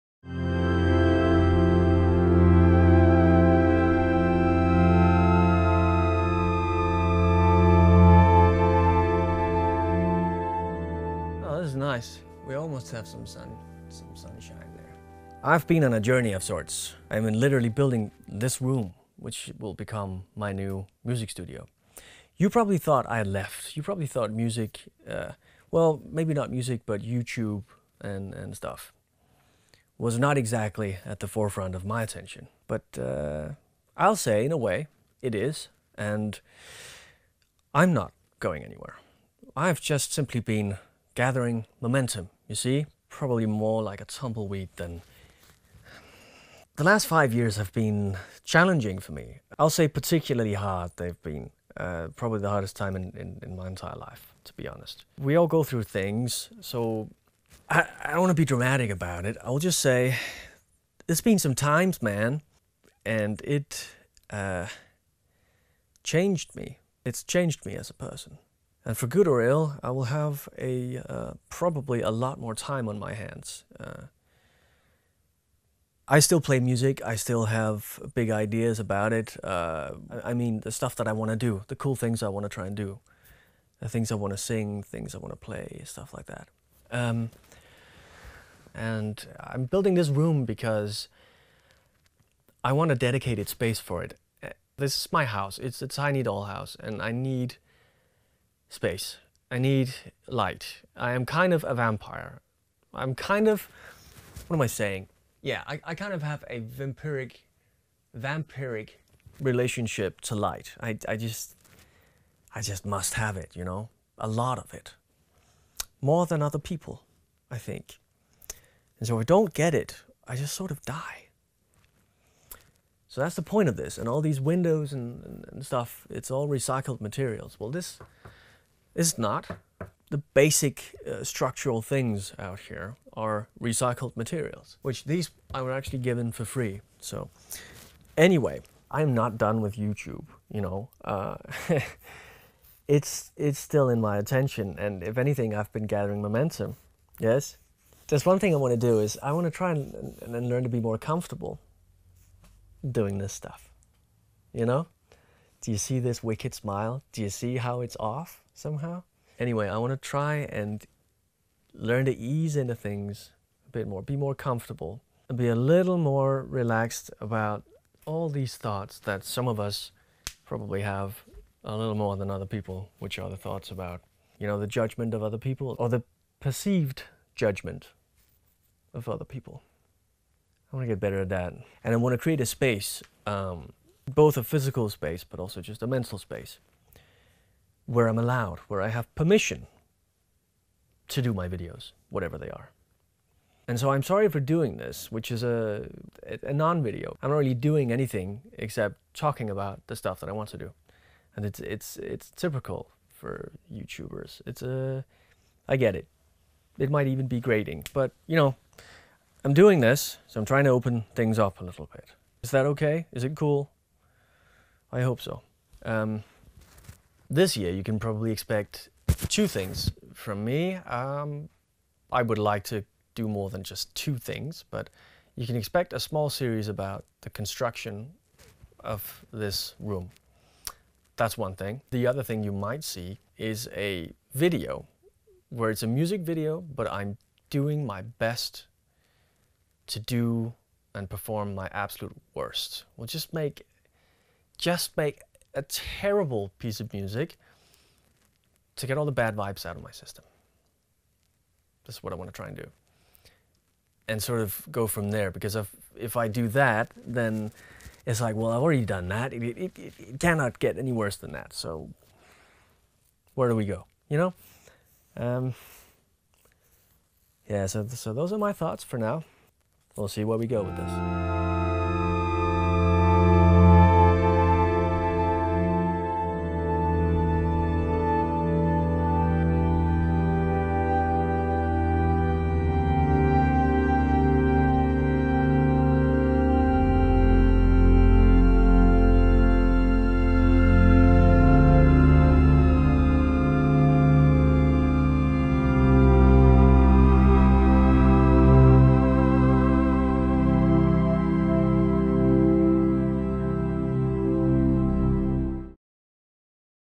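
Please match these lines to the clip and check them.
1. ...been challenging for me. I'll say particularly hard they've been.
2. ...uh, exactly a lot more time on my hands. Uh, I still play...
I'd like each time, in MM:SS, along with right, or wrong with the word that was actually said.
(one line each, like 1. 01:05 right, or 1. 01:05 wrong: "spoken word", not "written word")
1. 00:47 right
2. 01:11 wrong: "probably", not "exactly".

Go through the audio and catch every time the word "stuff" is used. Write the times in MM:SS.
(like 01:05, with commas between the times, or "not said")
00:28, 01:20, 01:25, 02:05, 02:33, 03:19.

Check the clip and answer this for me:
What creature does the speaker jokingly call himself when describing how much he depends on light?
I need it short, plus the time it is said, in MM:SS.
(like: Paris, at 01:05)
vampire, at 01:41.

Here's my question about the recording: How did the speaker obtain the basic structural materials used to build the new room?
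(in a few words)
given for free.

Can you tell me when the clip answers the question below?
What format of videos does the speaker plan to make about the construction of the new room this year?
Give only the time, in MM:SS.
03:45.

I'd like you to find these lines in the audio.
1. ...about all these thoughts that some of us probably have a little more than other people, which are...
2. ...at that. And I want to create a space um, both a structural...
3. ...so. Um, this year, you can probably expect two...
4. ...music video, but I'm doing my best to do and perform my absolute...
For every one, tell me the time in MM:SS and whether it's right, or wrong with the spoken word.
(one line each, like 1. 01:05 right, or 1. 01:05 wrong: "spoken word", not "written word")
1. 02:47 right
2. 03:01 wrong: "physical", not "structural"
3. 03:35 right
4. 03:55 right.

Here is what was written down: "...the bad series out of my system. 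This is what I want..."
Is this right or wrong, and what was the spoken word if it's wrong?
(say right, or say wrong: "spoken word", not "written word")
wrong: "vibes", not "series".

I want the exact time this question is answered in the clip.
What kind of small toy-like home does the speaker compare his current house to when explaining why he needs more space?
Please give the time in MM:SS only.
01:35.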